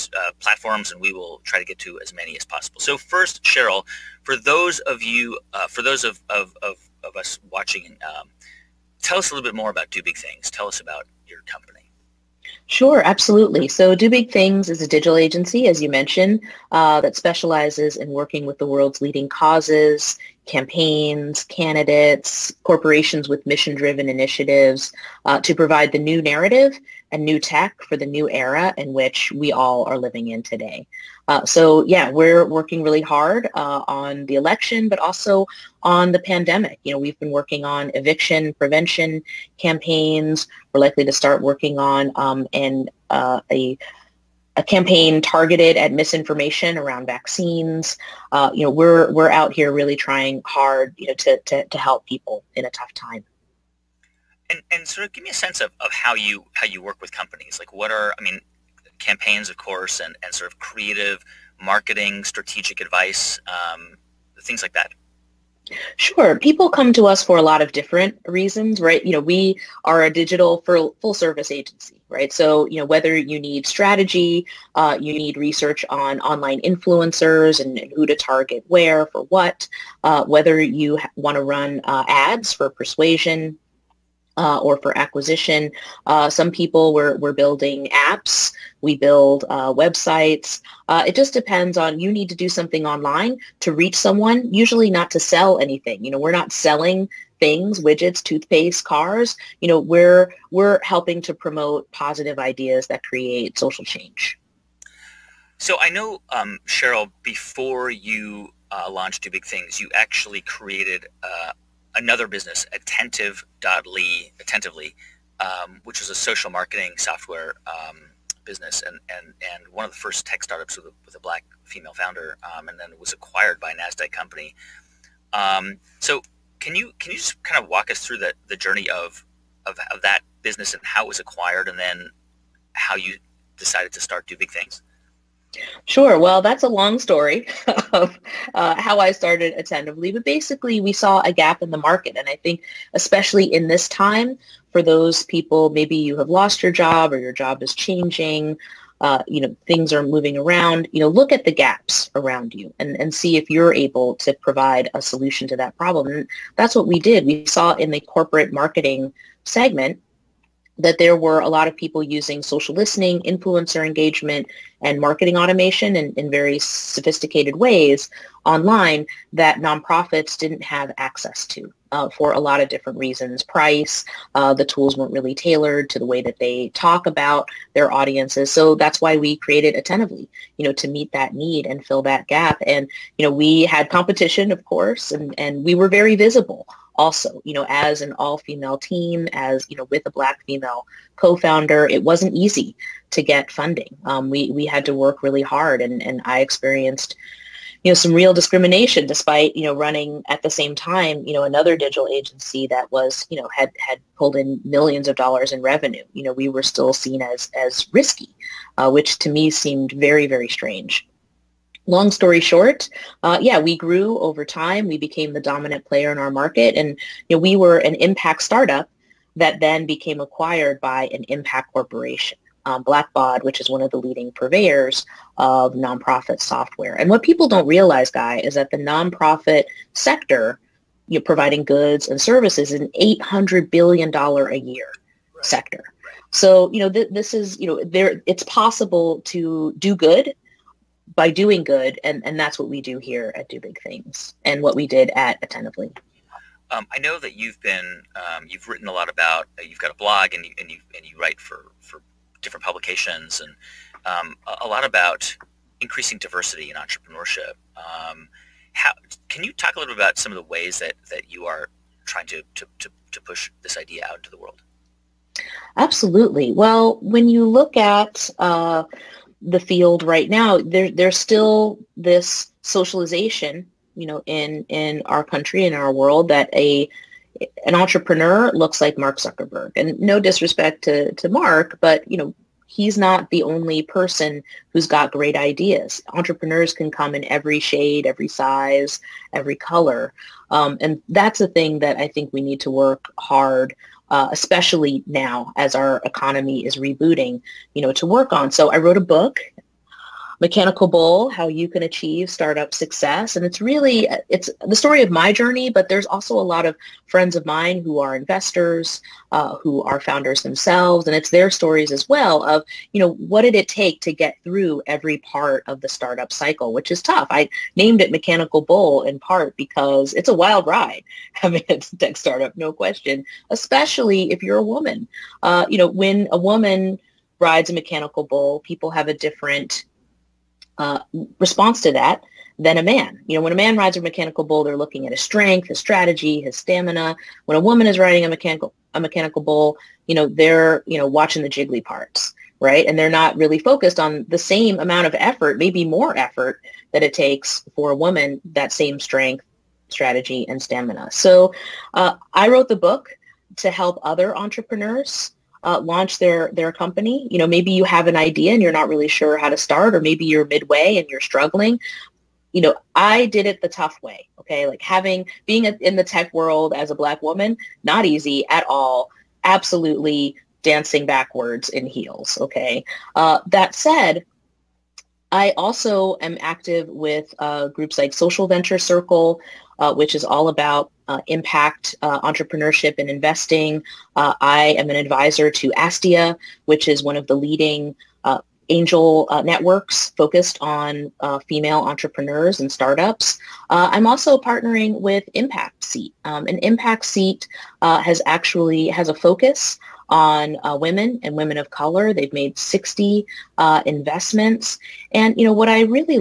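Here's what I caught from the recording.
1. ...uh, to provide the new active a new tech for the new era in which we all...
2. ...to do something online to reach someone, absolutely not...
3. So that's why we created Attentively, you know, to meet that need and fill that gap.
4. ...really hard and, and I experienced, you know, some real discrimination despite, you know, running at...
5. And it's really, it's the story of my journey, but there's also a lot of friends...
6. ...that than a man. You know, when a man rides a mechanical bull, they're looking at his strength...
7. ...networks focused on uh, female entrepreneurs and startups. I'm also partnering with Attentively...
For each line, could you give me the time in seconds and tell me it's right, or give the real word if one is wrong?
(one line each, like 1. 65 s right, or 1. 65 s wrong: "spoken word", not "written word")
1. 25 s wrong: "narrative", not "active"
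2. 92 s wrong: "usually", not "absolutely"
3. 178 s right
4. 195 s right
5. 303 s right
6. 331 s right
7. 389 s wrong: "Impact", not "Attentively".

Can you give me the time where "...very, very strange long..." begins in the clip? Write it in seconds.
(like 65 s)
209 s.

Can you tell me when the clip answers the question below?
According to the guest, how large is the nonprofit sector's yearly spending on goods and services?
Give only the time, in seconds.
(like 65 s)
233 s.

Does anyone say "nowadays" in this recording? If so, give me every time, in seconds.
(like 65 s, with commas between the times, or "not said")
not said.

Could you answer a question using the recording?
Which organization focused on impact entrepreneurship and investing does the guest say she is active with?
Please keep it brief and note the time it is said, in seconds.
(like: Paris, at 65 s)
Social Venture Circle, at 378 s.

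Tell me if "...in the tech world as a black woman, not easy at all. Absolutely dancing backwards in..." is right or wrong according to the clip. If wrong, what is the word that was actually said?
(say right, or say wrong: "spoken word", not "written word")
right.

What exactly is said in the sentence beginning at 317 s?
I named it Mechanical Bull in part because it's a wild ride.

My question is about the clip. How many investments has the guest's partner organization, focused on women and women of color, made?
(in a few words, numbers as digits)
60.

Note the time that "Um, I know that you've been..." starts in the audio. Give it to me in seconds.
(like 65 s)
246 s.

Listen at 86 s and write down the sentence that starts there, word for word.
Uh, some people were, were building apps.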